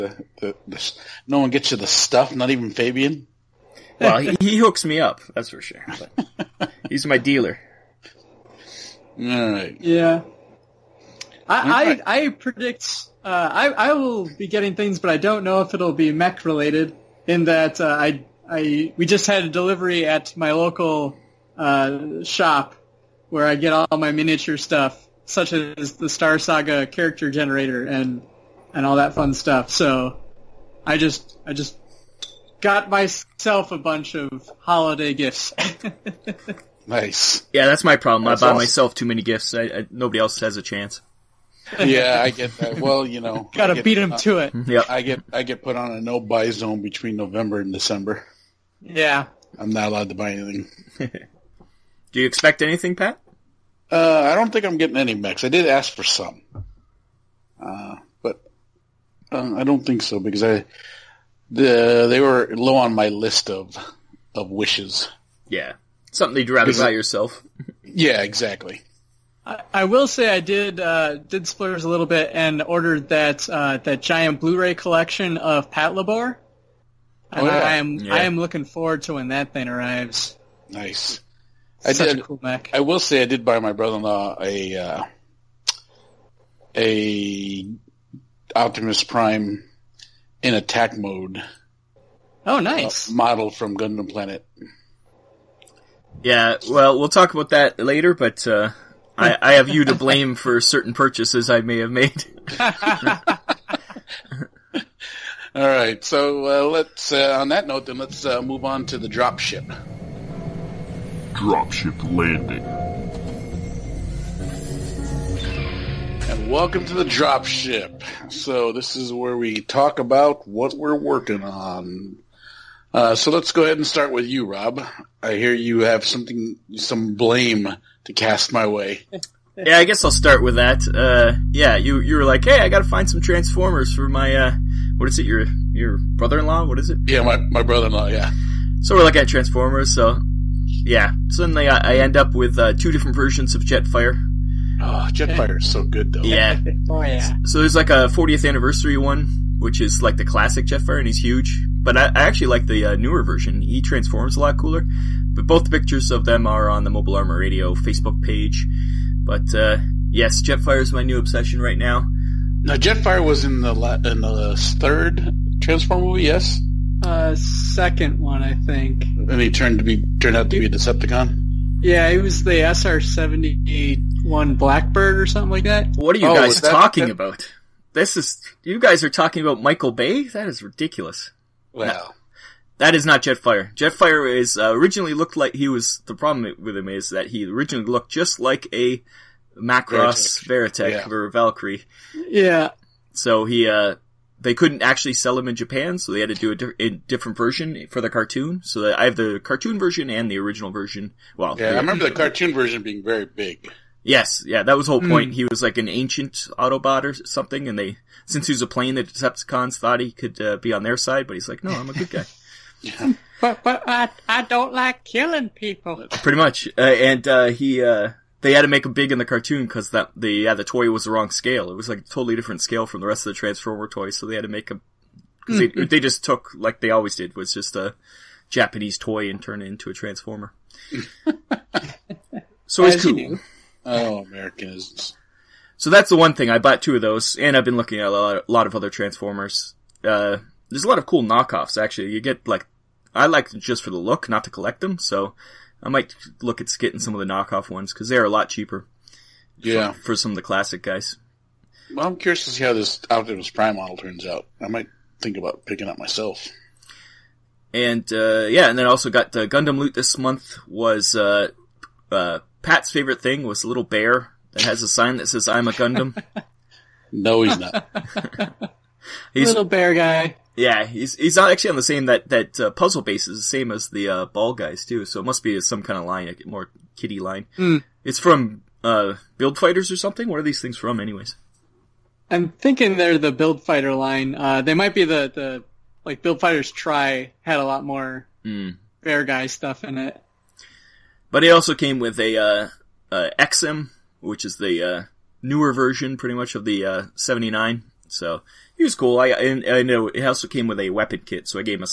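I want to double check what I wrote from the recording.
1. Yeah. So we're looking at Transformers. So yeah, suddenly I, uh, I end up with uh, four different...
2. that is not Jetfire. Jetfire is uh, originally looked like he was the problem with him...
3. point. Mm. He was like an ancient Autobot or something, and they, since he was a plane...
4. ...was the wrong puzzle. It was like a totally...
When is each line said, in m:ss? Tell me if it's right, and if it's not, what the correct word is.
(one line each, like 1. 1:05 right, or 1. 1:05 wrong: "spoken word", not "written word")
1. 2:18 wrong: "two", not "four"
2. 3:02 right
3. 3:25 right
4. 3:40 wrong: "scale", not "puzzle".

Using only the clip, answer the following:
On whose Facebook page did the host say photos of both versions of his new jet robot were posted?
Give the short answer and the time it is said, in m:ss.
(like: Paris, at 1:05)
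Mobile Armor Radio, at 2:36.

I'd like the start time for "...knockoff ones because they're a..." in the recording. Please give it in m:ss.
4:07.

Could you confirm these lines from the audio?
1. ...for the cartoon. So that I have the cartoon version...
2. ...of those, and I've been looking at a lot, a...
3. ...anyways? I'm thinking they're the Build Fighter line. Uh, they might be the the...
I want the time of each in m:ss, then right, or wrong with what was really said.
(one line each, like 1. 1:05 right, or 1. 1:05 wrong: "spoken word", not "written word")
1. 3:17 right
2. 3:56 right
3. 4:40 right.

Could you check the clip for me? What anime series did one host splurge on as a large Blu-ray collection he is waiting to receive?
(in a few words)
Patlabor.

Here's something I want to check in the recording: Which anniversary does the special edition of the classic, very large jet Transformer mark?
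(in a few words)
40th anniversary.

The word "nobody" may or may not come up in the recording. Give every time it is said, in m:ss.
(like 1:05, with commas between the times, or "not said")
0:39.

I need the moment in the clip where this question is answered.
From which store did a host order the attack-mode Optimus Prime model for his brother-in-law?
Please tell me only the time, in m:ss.
1:33.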